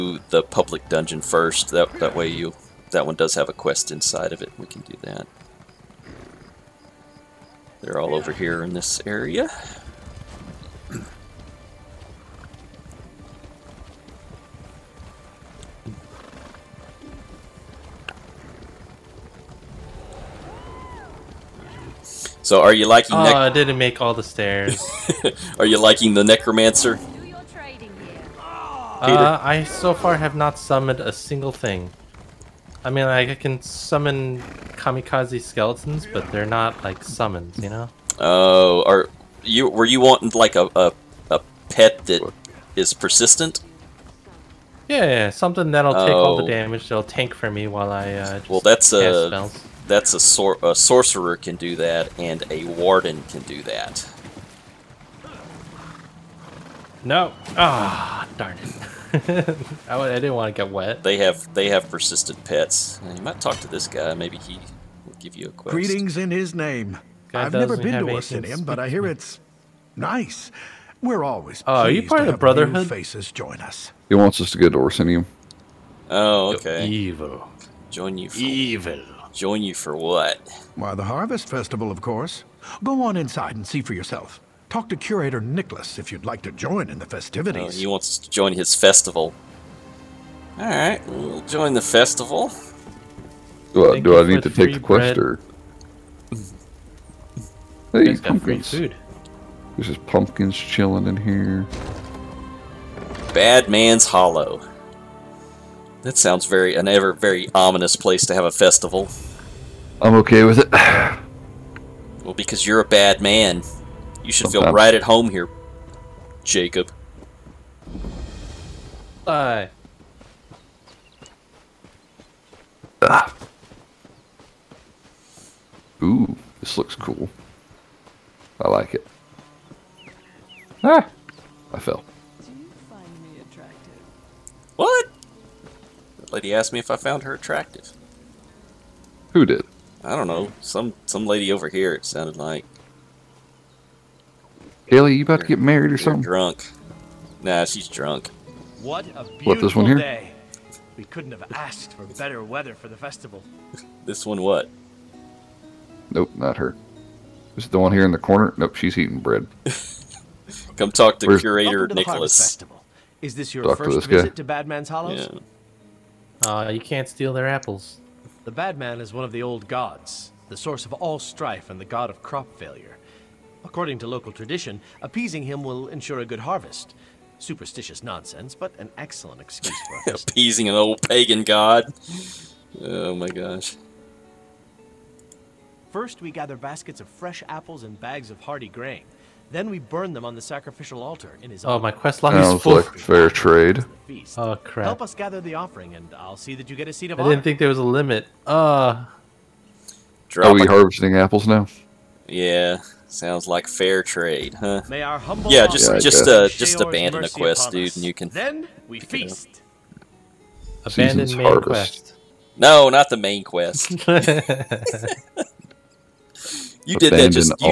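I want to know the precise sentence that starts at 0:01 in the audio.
That, that way you that one does have a quest inside of it.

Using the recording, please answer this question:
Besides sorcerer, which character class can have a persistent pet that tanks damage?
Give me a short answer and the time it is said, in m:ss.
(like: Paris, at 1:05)
Warden, at 0:52.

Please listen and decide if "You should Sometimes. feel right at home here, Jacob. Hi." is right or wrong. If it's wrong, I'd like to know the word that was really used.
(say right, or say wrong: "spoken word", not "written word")
right.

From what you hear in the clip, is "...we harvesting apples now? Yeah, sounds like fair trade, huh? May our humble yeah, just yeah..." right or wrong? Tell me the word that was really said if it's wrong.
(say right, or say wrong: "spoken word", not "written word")
right.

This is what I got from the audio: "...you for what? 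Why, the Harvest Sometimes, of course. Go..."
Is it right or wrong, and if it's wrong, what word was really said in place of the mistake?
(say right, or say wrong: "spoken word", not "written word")
wrong: "Festival", not "Sometimes".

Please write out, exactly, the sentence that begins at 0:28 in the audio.
Uh, I so far have not summoned a single thing.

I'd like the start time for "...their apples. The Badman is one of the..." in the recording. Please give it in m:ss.
2:47.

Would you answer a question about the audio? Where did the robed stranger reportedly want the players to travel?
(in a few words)
Orsinium.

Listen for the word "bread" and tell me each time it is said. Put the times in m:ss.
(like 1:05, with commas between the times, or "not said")
2:39.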